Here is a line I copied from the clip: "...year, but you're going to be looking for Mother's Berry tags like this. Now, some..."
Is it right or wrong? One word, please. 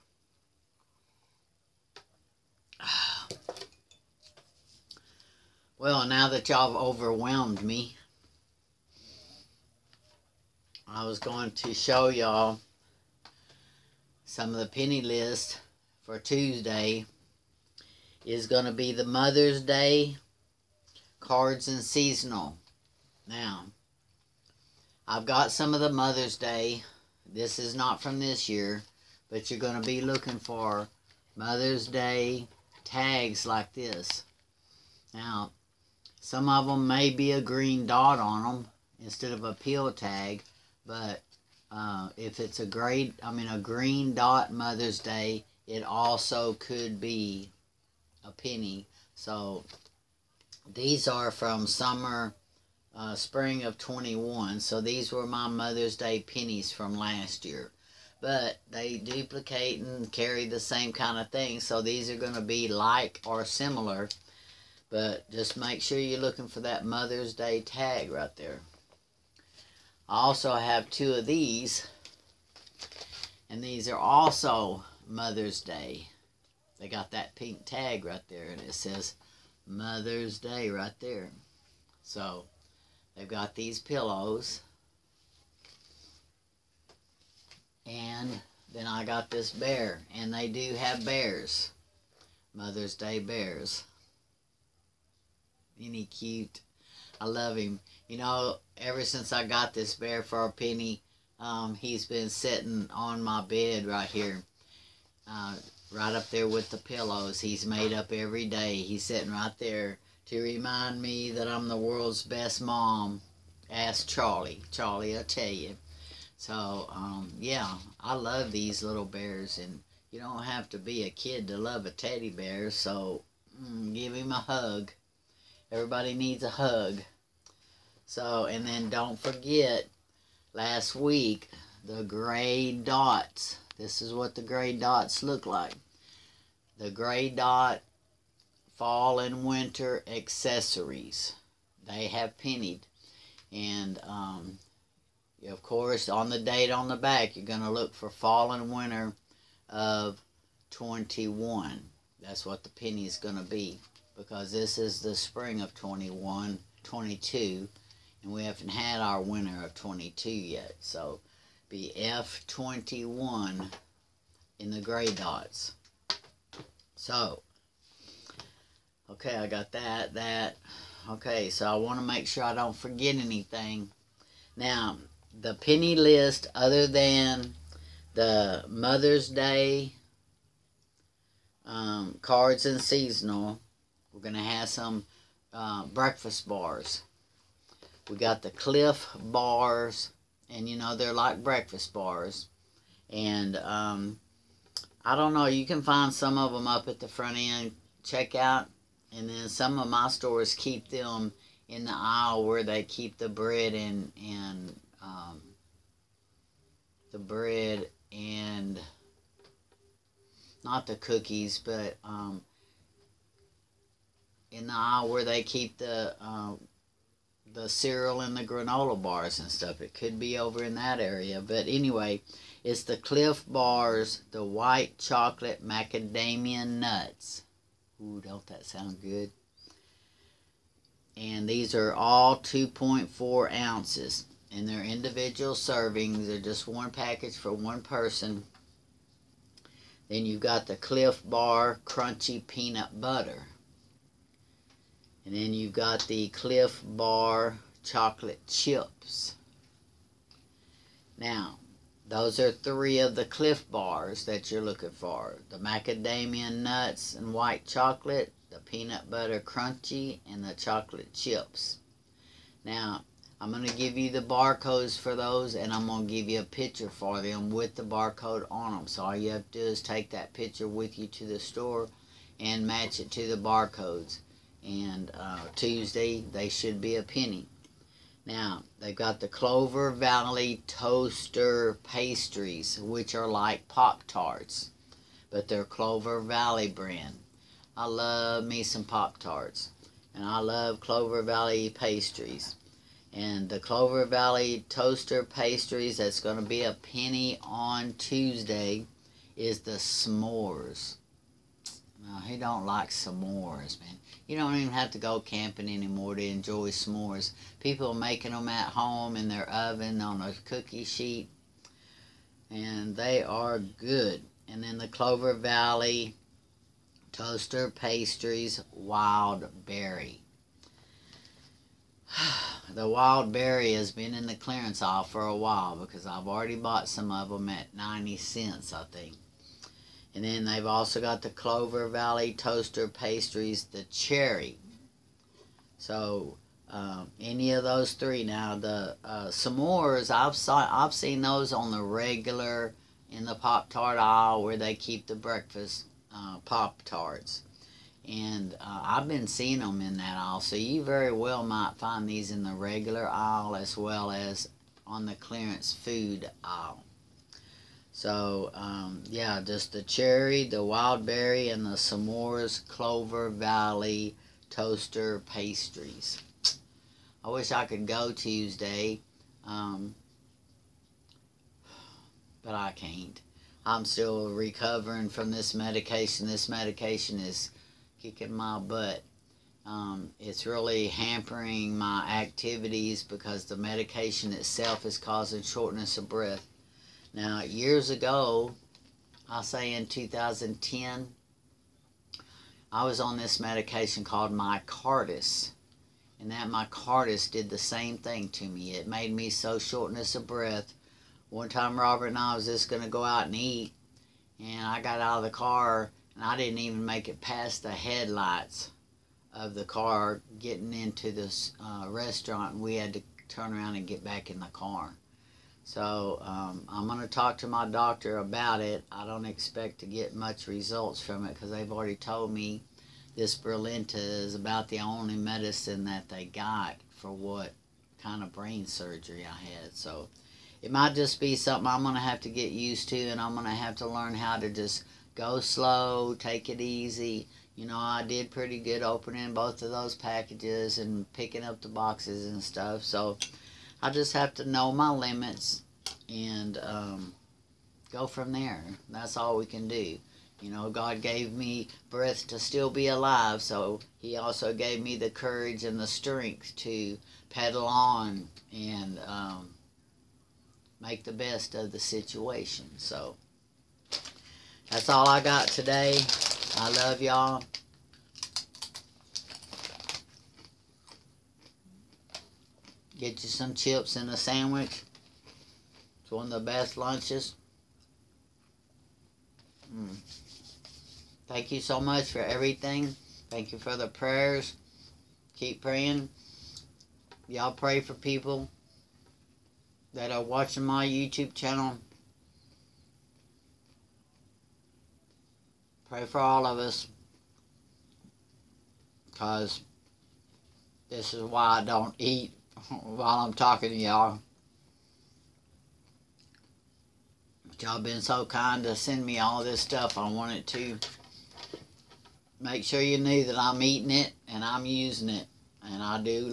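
wrong.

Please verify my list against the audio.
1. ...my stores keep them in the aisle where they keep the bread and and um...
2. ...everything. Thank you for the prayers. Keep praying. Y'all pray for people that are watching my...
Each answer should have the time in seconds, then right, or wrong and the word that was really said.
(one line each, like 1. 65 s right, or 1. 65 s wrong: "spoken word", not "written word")
1. 199 s right
2. 482 s right.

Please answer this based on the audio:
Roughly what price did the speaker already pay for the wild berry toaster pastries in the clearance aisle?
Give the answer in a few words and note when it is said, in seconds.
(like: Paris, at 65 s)
90 cents, at 327 s.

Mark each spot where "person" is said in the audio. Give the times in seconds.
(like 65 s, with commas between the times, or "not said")
237 s.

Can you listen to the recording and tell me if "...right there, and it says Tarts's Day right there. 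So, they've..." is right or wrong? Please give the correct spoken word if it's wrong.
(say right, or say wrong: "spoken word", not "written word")
wrong: "Mother", not "Tarts".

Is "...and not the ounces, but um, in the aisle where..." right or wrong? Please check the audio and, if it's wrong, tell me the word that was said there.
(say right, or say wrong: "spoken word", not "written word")
wrong: "cookies", not "ounces".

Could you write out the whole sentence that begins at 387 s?
Now, years ago, I'll say in 2010, I was on this medication called Micardis.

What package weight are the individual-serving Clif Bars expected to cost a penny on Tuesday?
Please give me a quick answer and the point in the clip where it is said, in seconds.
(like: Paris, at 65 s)
2.4 ounces, at 232 s.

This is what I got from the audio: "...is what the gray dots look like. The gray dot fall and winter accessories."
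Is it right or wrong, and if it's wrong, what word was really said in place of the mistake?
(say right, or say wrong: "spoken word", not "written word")
right.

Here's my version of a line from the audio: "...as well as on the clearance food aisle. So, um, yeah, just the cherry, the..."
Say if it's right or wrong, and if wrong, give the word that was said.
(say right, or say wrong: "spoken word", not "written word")
right.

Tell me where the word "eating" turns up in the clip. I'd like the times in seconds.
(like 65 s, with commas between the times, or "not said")
513 s.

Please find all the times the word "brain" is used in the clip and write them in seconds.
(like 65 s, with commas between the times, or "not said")
428 s.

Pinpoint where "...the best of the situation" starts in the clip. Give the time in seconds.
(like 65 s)
461 s.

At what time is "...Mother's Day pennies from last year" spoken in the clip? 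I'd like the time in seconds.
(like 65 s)
55 s.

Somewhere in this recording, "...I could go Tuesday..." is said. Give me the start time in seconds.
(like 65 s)
367 s.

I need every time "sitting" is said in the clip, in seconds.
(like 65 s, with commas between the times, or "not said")
102 s, 109 s.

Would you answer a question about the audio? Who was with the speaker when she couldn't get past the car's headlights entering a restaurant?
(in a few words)
Robert.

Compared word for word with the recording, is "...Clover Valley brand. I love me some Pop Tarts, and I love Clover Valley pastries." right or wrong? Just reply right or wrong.
right.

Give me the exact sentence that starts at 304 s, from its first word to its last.
You don't even have to go camping anymore to enjoy s'mores.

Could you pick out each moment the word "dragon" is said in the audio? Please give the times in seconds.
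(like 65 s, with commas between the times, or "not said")
not said.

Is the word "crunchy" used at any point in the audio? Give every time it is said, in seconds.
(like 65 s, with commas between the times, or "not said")
241 s, 259 s.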